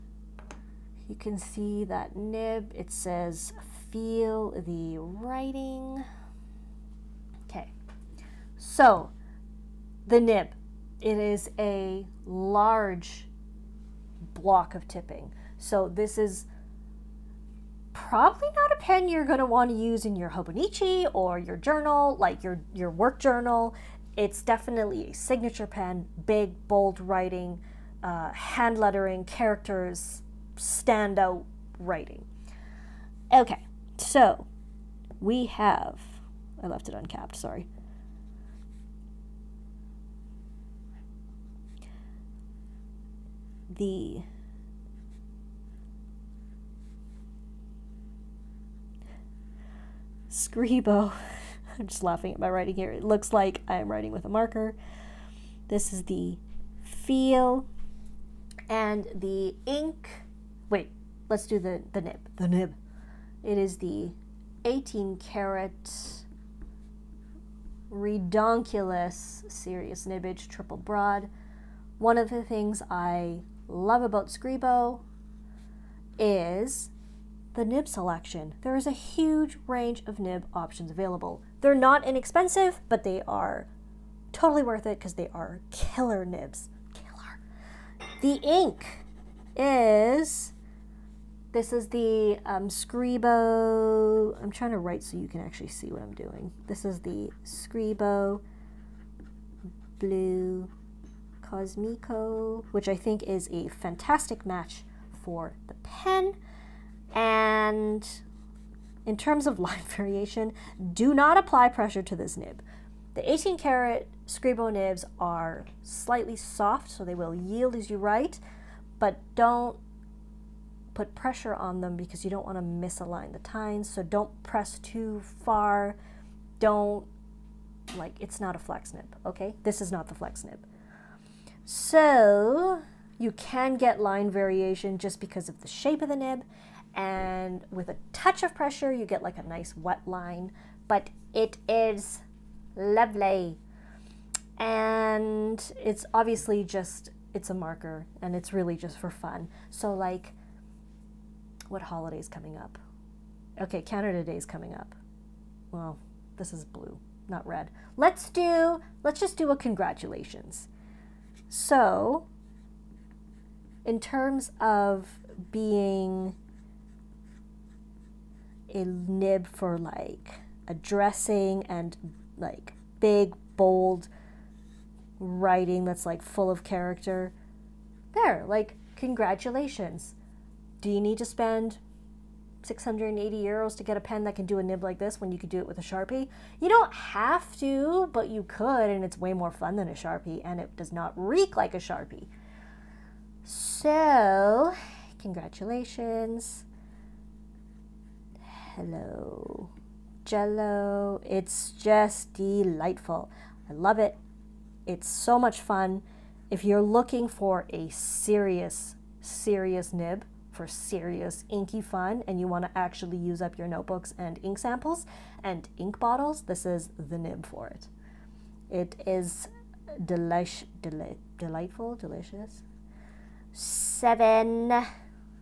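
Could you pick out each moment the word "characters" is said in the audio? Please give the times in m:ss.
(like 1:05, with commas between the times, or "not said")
0:29, 2:56.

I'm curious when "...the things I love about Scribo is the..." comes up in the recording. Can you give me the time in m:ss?
1:12.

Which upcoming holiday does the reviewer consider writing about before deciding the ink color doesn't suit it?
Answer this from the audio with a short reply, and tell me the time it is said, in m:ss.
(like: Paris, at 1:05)
Canada Day, at 2:33.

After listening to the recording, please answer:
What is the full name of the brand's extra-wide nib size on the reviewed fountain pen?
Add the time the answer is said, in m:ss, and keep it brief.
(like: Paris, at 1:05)
18 karat redonkulous serious nibbage triple broad, at 1:04.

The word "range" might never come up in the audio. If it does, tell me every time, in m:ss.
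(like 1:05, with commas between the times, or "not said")
1:19.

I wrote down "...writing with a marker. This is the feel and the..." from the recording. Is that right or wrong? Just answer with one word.
right.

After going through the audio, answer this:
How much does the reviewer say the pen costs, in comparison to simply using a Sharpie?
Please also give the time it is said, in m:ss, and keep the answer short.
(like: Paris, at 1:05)
680 euros, at 3:02.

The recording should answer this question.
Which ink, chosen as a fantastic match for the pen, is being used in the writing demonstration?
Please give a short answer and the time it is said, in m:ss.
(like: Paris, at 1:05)
Scribo Blue Cosmico, at 1:37.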